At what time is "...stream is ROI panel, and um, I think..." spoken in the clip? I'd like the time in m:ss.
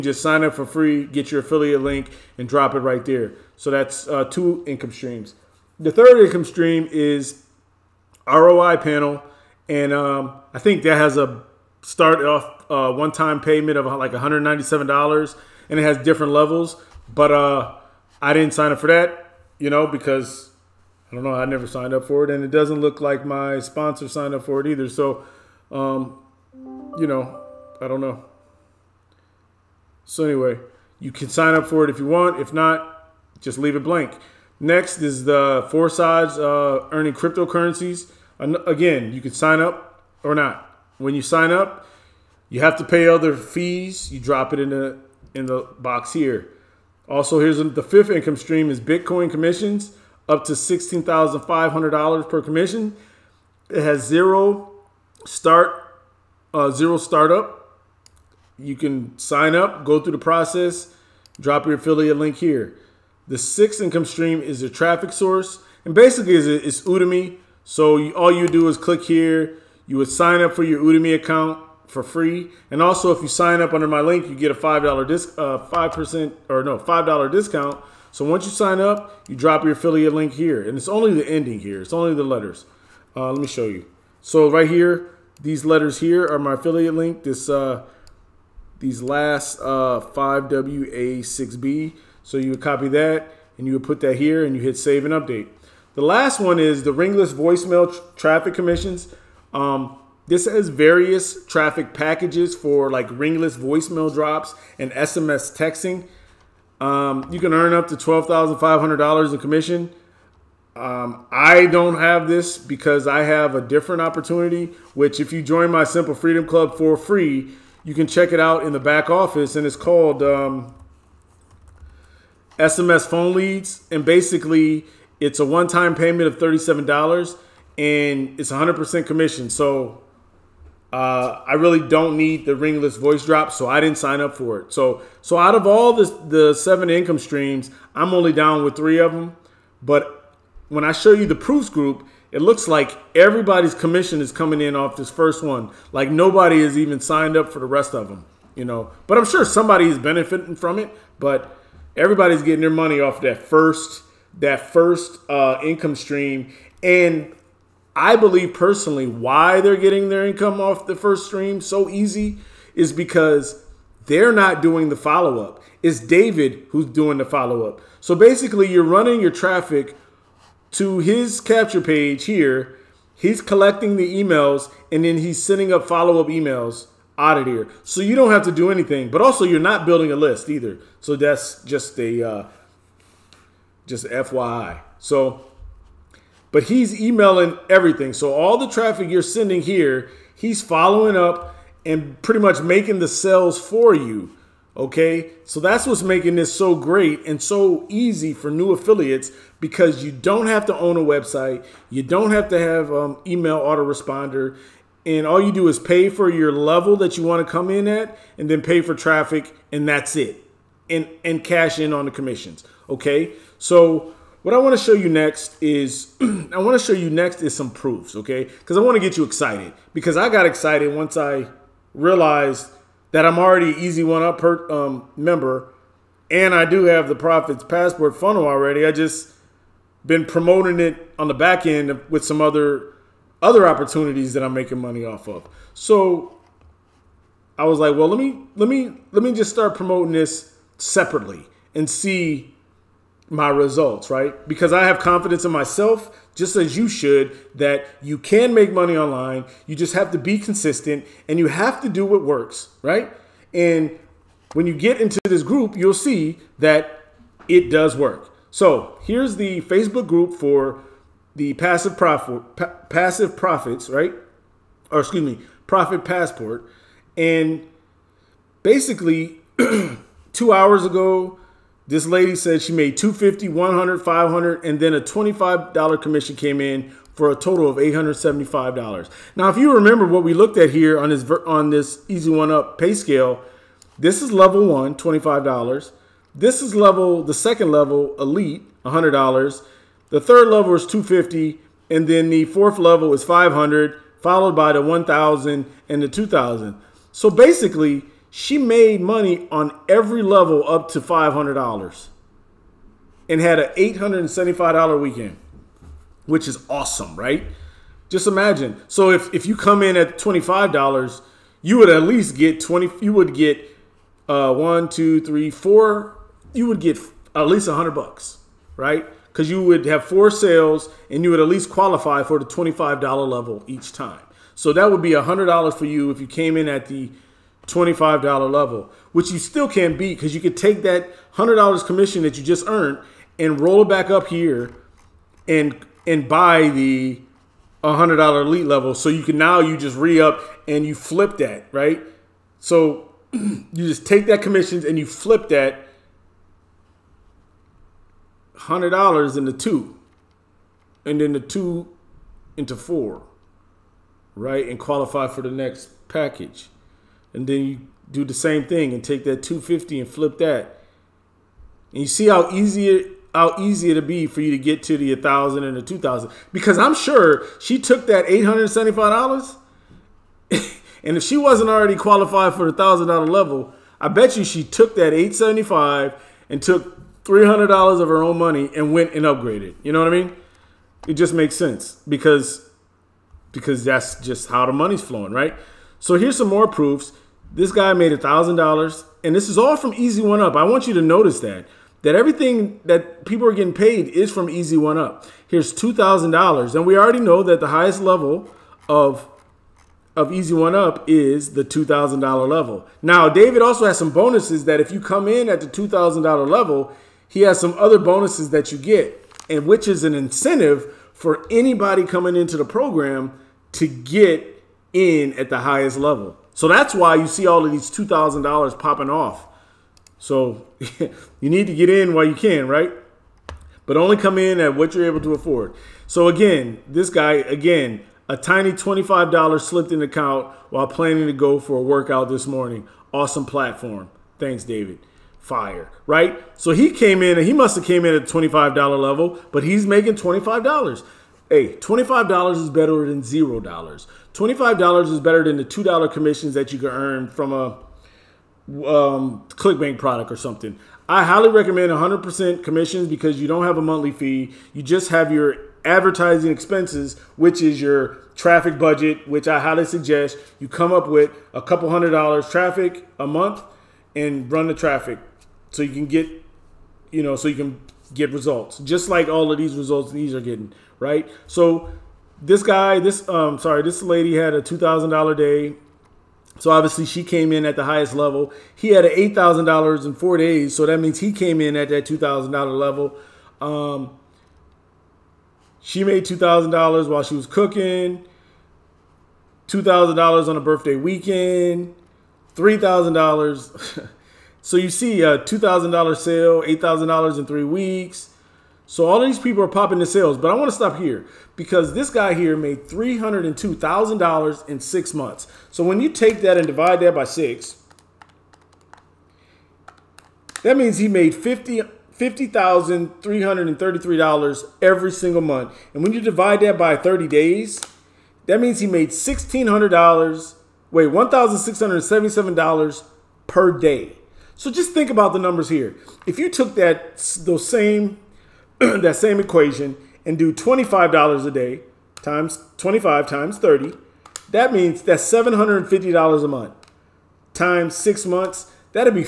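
0:06.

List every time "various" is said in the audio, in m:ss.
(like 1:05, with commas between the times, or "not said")
1:40.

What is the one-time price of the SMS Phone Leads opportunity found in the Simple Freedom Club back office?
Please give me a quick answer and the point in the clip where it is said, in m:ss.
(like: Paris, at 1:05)
$37, at 2:06.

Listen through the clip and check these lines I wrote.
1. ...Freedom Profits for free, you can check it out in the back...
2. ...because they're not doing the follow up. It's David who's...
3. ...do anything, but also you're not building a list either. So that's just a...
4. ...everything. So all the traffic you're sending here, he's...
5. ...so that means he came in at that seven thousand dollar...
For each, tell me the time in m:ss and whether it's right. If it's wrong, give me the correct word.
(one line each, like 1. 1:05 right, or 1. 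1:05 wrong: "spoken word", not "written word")
1. 1:56 wrong: "Club", not "Profits"
2. 2:42 right
3. 2:58 right
4. 3:07 right
5. 8:00 wrong: "two", not "seven".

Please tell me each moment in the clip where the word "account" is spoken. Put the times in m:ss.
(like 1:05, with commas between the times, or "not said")
1:11, 7:09.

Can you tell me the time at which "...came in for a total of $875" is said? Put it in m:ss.
4:36.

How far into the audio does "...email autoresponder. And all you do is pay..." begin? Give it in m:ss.
3:23.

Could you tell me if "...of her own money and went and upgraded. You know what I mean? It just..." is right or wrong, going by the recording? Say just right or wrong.
right.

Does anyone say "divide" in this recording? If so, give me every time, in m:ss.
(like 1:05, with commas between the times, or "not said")
8:26, 8:36.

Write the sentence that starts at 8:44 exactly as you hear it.
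So just think about the numbers here.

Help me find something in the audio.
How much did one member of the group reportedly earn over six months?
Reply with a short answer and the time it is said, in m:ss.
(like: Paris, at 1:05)
$302,000, at 8:22.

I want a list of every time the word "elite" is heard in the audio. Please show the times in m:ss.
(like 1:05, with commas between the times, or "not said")
4:48, 5:38.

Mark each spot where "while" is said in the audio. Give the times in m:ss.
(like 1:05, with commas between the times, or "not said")
7:02, 7:10, 8:07.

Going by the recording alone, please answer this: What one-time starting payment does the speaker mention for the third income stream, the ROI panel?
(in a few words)
$197.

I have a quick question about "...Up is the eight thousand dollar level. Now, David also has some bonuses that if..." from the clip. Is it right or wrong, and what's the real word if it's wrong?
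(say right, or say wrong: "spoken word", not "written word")
wrong: "two", not "eight".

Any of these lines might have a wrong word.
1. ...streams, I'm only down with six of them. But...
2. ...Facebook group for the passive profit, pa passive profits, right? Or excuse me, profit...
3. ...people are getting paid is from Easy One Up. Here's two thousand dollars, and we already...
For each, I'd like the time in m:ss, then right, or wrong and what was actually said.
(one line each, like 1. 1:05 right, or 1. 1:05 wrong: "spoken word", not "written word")
1. 2:17 wrong: "three", not "six"
2. 4:19 right
3. 6:33 right.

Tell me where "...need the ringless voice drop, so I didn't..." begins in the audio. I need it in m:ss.
2:12.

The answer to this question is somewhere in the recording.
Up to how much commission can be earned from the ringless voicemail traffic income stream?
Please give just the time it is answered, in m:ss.
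1:47.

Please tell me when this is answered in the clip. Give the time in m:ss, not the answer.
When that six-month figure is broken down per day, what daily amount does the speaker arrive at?
8:41.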